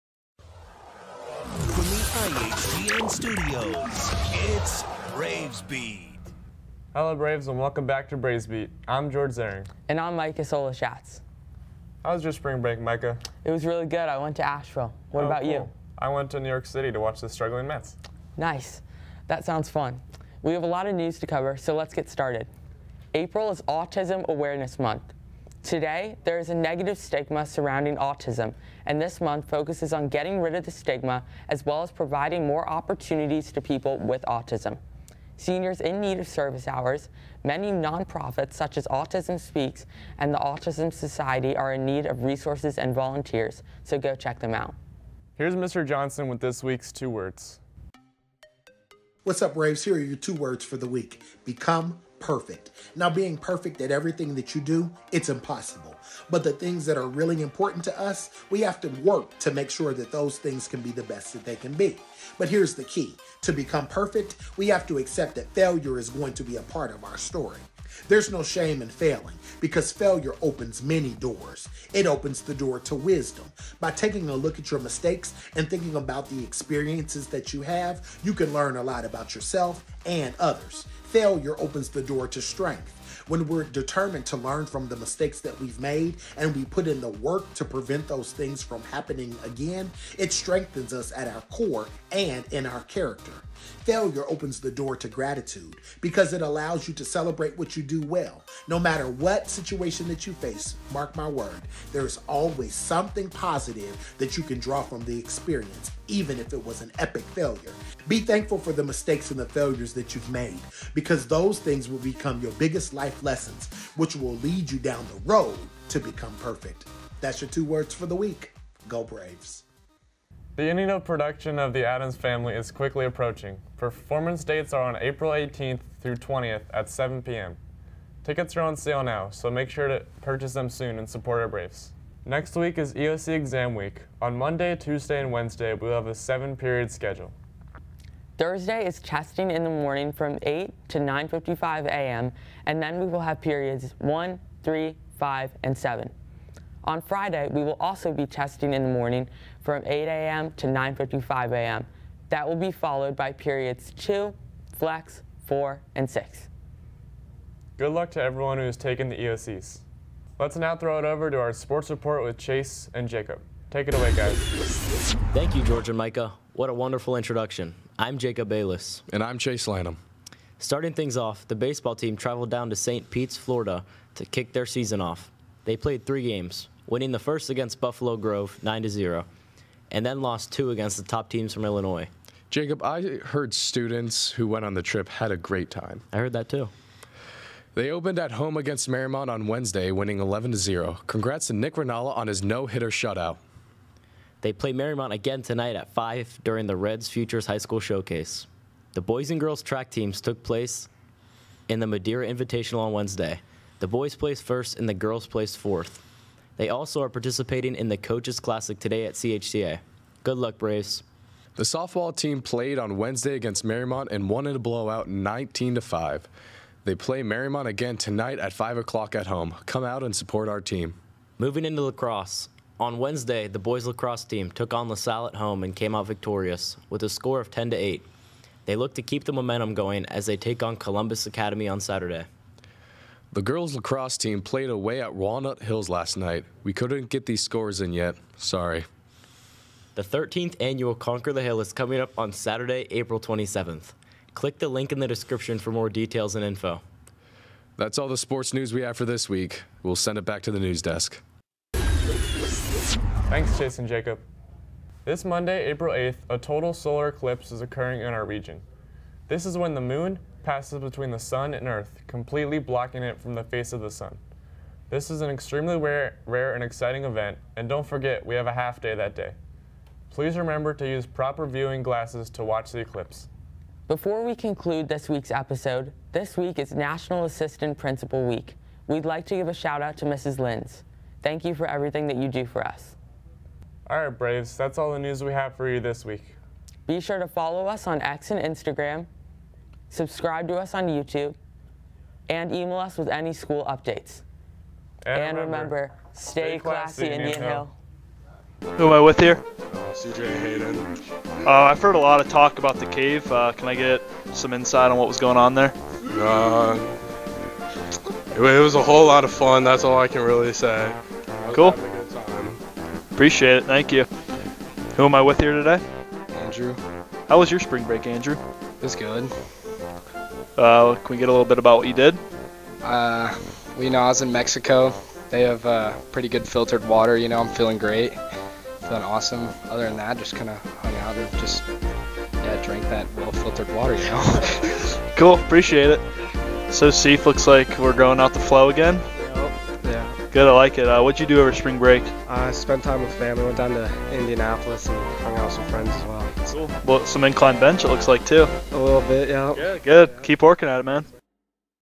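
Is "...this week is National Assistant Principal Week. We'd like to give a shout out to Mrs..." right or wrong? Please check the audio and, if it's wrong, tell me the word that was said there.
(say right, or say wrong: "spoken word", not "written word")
right.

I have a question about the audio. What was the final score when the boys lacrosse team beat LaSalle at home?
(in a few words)
10 to 8.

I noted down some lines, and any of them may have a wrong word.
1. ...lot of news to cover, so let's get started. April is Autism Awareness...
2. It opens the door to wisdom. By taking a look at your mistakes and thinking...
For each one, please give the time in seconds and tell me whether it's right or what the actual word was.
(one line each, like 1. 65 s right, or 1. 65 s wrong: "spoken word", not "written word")
1. 20 s right
2. 71 s right.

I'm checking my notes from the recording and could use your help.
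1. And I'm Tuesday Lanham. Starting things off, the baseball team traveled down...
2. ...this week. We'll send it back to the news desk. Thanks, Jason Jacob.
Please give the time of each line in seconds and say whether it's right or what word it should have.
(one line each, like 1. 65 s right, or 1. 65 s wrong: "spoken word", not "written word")
1. 169 s wrong: "Chase", not "Tuesday"
2. 249 s right.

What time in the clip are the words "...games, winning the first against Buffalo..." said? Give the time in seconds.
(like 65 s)
176 s.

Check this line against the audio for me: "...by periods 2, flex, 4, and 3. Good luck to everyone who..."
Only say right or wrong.
wrong.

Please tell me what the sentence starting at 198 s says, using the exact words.
The boys and girls track teams took place in the Madeira Invitational on Wednesday.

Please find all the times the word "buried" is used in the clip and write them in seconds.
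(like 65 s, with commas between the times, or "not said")
not said.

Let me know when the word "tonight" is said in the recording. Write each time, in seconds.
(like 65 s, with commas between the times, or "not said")
195 s, 217 s.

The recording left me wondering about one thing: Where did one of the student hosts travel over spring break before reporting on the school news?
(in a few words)
Asheville.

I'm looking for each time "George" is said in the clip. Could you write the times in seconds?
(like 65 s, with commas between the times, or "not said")
9 s, 165 s.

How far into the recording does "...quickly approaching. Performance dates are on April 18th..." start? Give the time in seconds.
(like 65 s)
122 s.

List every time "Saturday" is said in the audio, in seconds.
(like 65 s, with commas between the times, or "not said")
231 s, 242 s.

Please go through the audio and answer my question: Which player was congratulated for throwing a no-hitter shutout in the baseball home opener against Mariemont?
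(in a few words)
Nick Ranala.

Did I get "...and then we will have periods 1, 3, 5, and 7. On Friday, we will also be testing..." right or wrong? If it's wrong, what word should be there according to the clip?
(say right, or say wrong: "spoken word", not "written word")
right.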